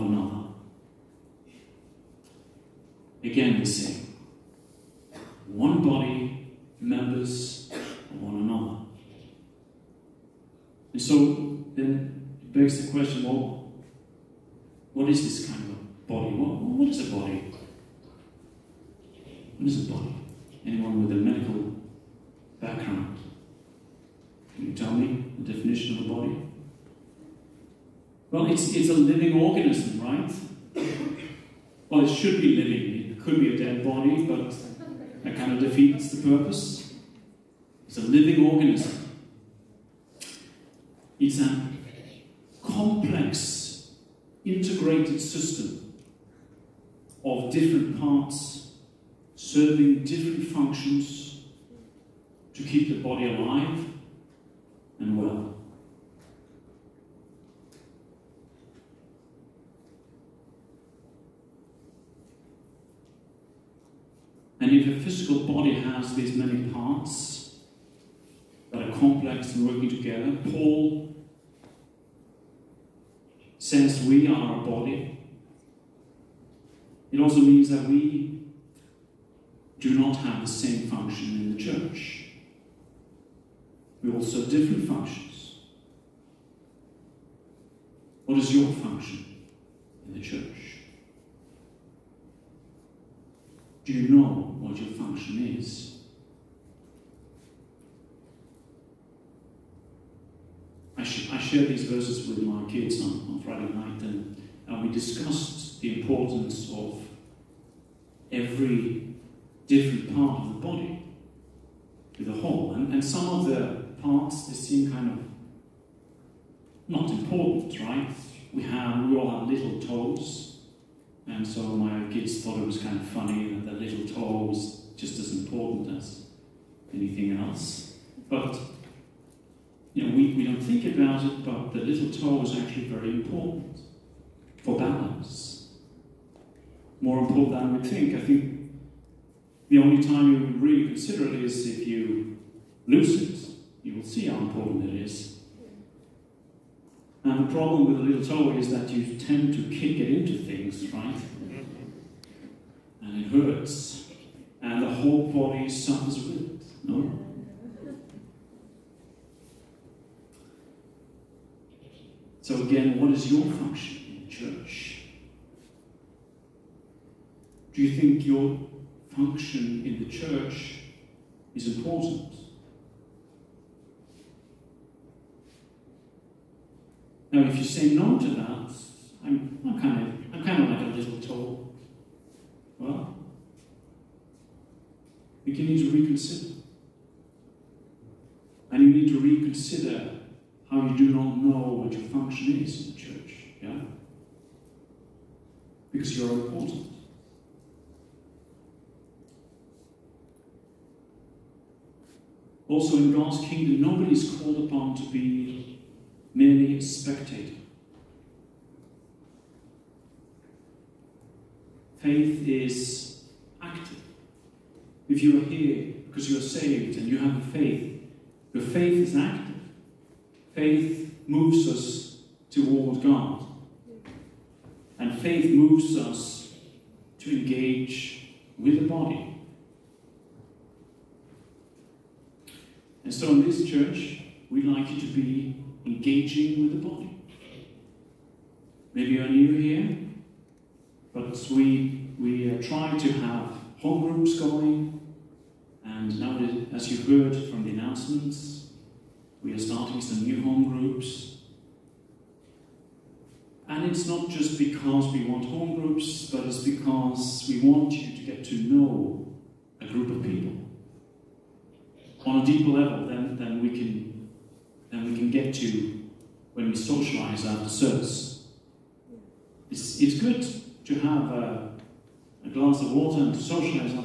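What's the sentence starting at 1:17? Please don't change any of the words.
It also means that we do not have the same function in the church.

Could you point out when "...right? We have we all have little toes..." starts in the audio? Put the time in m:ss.
1:57.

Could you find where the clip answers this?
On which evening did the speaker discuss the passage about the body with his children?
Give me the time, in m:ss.
1:43.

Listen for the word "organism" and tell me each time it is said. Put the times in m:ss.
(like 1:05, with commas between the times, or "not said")
0:29, 0:38.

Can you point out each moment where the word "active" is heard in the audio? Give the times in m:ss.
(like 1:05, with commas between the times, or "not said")
3:33, 3:39.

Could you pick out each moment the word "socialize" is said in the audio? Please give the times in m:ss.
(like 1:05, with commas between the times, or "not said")
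4:26, 4:33.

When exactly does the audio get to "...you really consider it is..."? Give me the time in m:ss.
2:20.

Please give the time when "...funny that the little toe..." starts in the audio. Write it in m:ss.
2:03.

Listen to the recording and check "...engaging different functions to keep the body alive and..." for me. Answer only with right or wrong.
wrong.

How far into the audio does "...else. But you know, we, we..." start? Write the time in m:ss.
2:07.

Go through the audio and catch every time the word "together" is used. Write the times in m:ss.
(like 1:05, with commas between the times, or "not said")
1:09.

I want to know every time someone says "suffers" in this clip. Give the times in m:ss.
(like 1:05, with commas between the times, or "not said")
2:35.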